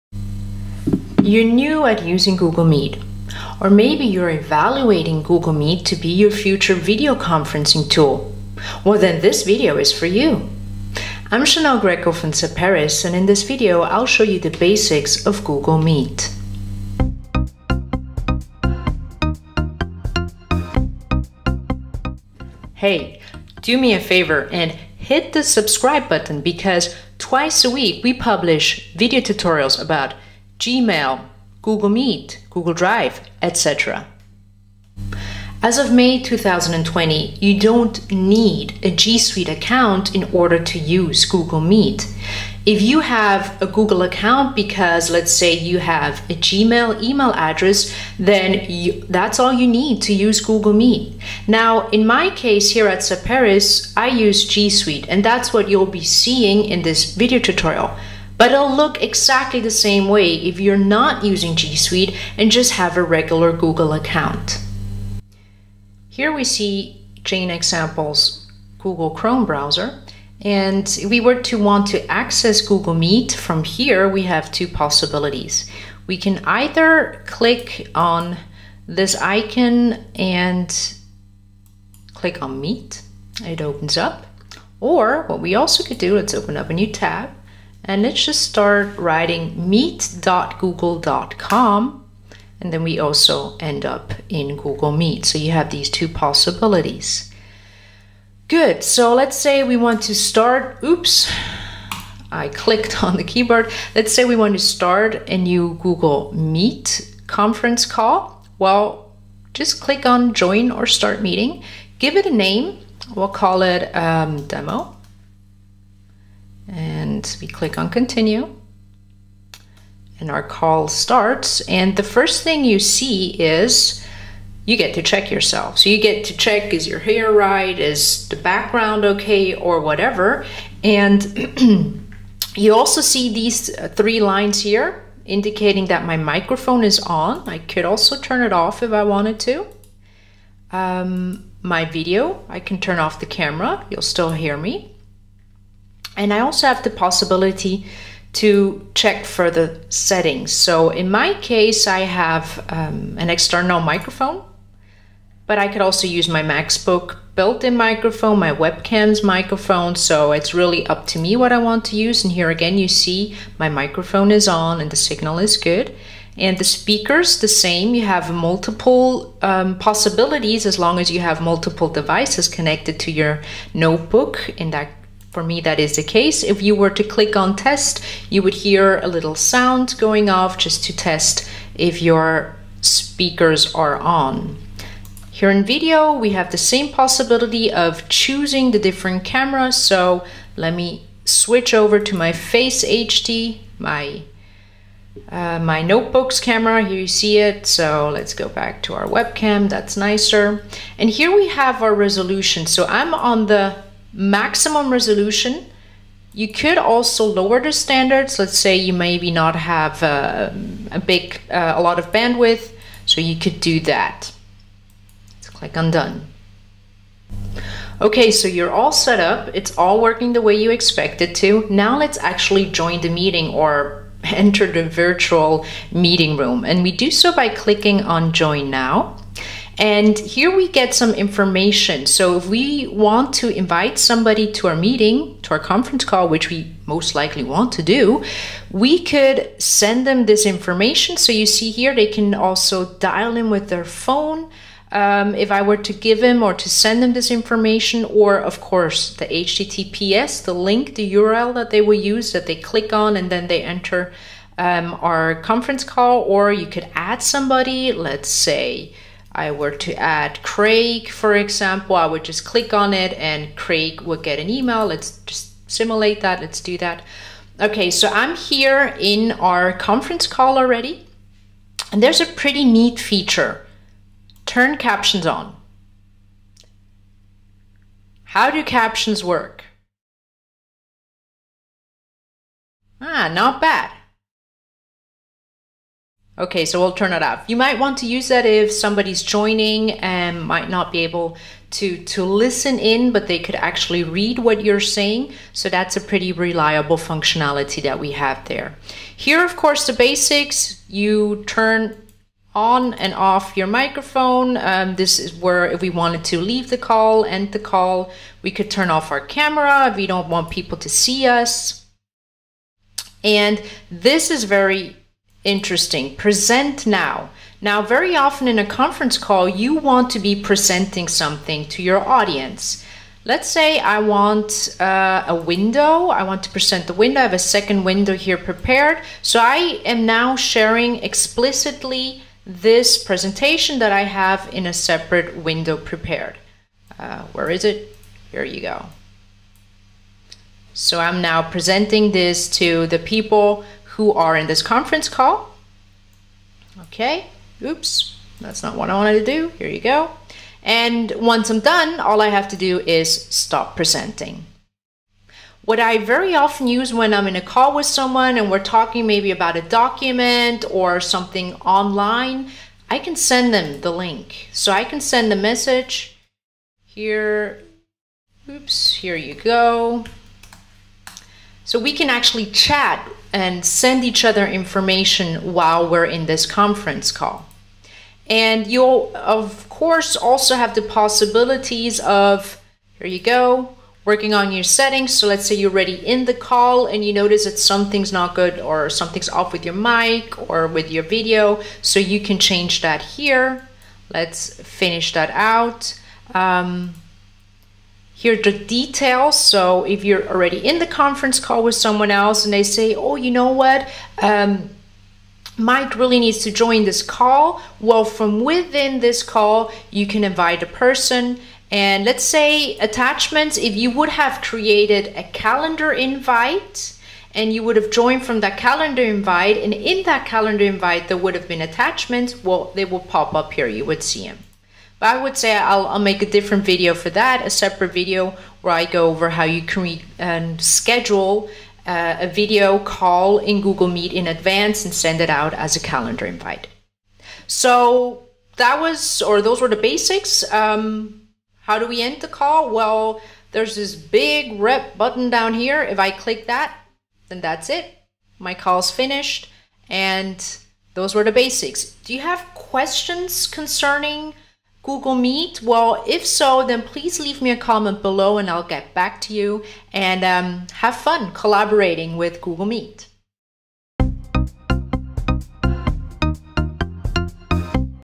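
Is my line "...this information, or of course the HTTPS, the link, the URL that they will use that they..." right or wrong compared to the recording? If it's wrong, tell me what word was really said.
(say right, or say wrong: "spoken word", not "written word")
right.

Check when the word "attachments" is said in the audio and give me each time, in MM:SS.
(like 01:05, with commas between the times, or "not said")
06:52, 07:01.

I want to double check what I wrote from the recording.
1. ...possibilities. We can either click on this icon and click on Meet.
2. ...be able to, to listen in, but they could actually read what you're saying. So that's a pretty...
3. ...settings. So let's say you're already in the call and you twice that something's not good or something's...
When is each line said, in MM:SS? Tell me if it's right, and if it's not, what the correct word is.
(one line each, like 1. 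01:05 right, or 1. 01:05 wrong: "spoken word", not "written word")
1. 01:14 right
2. 04:50 right
3. 06:24 wrong: "notice", not "twice".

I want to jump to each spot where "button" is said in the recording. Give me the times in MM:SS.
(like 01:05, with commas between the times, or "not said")
00:26, 07:24.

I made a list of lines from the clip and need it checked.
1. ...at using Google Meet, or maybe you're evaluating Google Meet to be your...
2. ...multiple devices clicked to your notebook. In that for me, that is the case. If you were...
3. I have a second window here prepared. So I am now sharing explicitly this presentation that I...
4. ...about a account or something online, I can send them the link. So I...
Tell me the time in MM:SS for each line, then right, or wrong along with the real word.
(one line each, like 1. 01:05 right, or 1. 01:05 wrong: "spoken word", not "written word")
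1. 00:01 right
2. 02:51 wrong: "connected", not "clicked"
3. 05:27 right
4. 05:59 wrong: "document", not "account".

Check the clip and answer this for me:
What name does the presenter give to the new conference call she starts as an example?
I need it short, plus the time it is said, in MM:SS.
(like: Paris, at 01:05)
demo, at 01:54.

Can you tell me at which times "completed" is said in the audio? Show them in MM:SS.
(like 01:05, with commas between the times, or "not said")
not said.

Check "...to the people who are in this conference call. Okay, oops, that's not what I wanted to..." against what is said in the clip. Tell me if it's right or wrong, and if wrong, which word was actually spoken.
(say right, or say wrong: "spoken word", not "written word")
right.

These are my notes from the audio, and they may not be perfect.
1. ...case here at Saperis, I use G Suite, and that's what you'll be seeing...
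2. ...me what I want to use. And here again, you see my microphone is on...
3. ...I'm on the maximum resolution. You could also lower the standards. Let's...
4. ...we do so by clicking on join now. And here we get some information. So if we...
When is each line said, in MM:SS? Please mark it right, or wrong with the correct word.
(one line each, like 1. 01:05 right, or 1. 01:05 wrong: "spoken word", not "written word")
1. 00:52 right
2. 02:41 right
3. 03:22 right
4. 03:46 right.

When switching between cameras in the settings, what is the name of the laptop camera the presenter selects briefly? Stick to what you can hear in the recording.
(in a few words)
Face HD.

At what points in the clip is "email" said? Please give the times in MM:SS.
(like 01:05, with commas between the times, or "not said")
00:47, 04:24.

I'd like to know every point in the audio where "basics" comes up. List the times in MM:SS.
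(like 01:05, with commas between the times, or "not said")
00:14, 04:59, 07:19, 07:31.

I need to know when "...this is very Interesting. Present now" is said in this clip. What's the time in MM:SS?
05:13.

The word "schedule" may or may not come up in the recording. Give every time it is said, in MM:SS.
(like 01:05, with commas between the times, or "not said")
07:10.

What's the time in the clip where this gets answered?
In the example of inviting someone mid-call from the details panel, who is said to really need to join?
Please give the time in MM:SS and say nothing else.
06:45.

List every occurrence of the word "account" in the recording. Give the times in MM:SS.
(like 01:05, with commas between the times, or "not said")
00:39, 00:44, 01:03.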